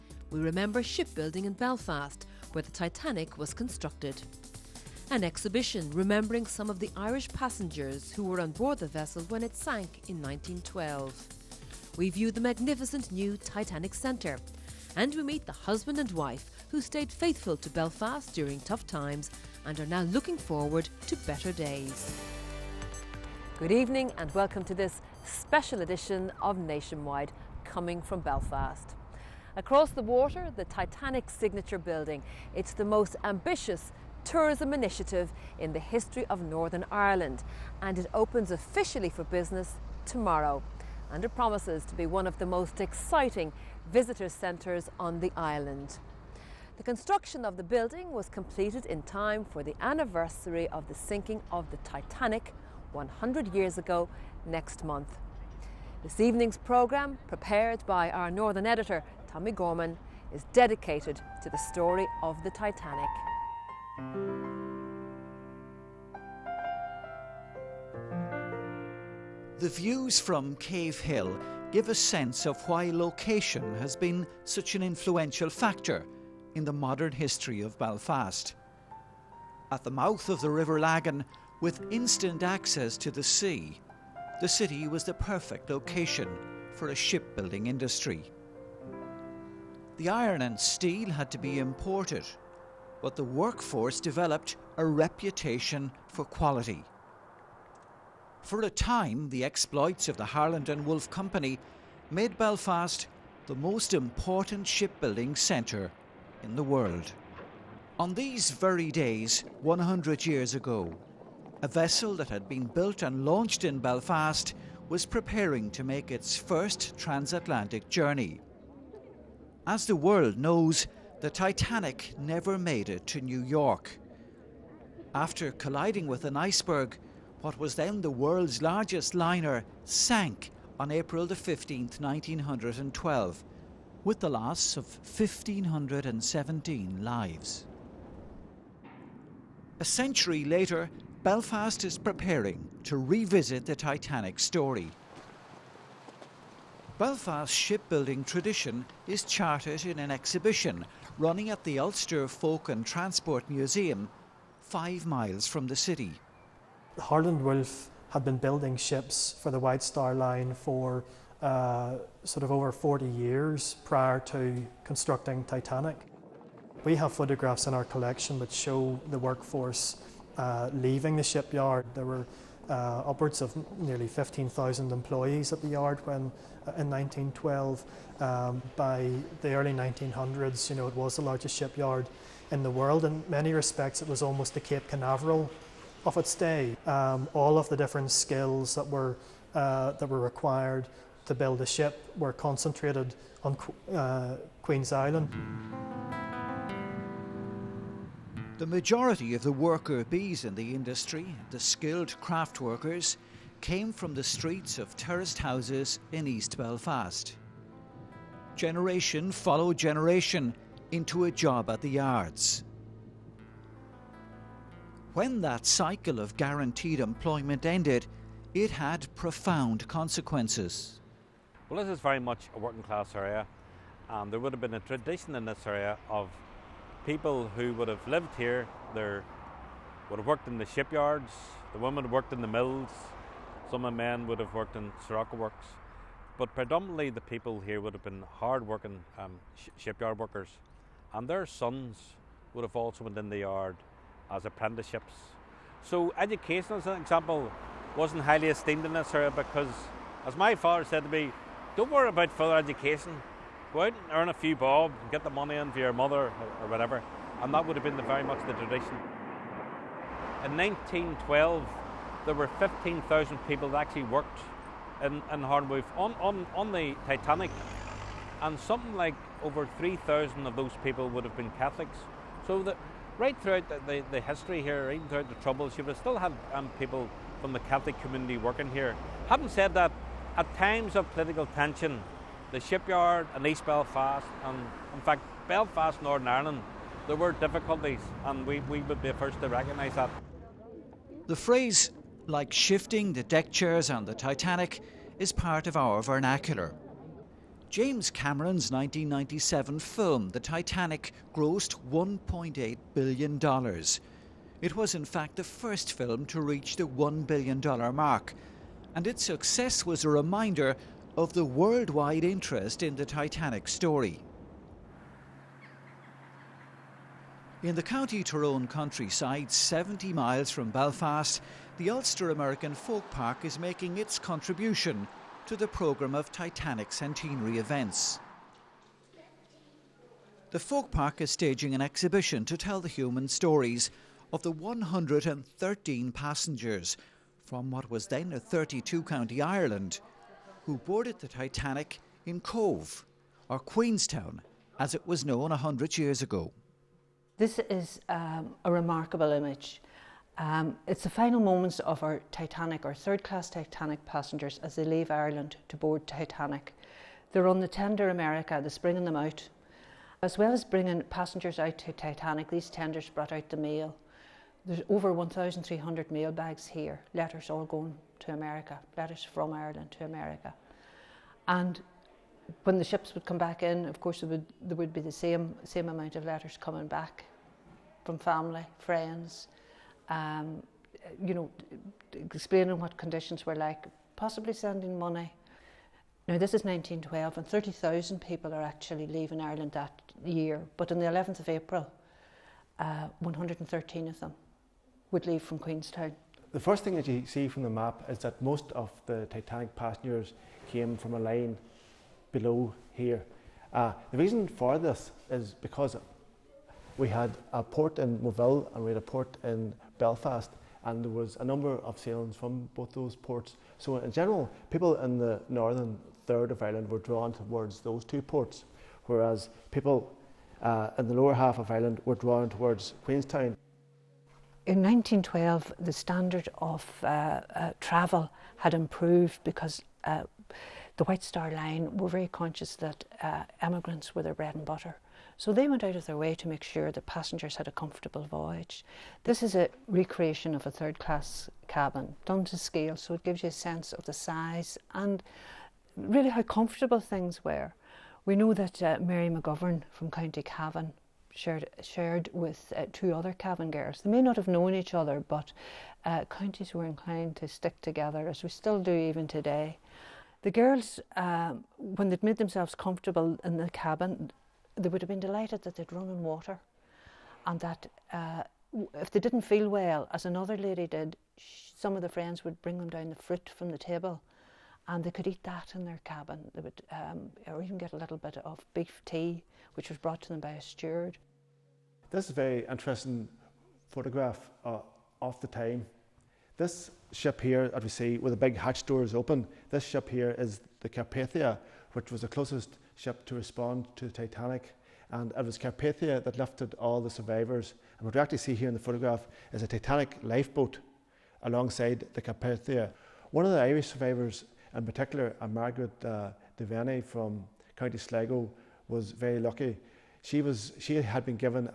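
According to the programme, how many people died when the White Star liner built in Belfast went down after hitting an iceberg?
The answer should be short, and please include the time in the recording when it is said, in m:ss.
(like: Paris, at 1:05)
1,517, at 2:14.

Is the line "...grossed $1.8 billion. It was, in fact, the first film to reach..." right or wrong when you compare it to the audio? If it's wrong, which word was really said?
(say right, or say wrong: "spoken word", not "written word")
right.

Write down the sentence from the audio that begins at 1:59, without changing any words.
As the world knows, the Titanic never made it to New York.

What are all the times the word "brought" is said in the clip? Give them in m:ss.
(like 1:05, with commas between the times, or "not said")
6:03, 7:59.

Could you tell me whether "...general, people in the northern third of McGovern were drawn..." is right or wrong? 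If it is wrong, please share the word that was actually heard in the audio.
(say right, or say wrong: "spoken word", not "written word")
wrong: "Ireland", not "McGovern".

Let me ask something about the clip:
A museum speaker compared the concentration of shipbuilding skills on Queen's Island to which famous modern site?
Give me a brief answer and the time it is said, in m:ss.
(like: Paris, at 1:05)
Cape Canaveral, at 3:04.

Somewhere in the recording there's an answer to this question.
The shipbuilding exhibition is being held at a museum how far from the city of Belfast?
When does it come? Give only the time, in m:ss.
2:34.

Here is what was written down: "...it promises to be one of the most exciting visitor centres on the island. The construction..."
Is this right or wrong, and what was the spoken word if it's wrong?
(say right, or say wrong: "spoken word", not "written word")
right.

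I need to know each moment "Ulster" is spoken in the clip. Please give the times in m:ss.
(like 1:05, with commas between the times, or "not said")
2:31, 5:21.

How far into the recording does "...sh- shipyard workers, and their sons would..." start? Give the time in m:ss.
3:59.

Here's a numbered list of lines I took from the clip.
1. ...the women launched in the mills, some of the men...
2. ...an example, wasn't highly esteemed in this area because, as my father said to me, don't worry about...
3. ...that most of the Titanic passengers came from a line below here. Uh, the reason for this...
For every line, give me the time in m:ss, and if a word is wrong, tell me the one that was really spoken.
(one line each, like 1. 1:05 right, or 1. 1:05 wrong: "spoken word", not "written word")
1. 3:51 wrong: "worked", not "launched"
2. 4:06 right
3. 6:38 right.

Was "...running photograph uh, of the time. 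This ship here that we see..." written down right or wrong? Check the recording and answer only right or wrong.
wrong.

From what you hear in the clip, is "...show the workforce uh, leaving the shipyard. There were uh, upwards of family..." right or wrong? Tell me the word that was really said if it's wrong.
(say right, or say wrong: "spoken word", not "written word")
wrong: "nearly", not "family".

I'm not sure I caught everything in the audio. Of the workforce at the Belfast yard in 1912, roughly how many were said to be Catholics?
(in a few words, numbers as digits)
over 3,000.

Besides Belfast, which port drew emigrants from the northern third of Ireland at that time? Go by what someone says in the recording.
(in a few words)
Moville.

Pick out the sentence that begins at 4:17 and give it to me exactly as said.
And that would have been the, very much the tradition.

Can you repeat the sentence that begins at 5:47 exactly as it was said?
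This is um, a remarkable image.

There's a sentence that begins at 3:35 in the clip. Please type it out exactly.
When that cycle of guaranteed employment ended, it had profound consequences.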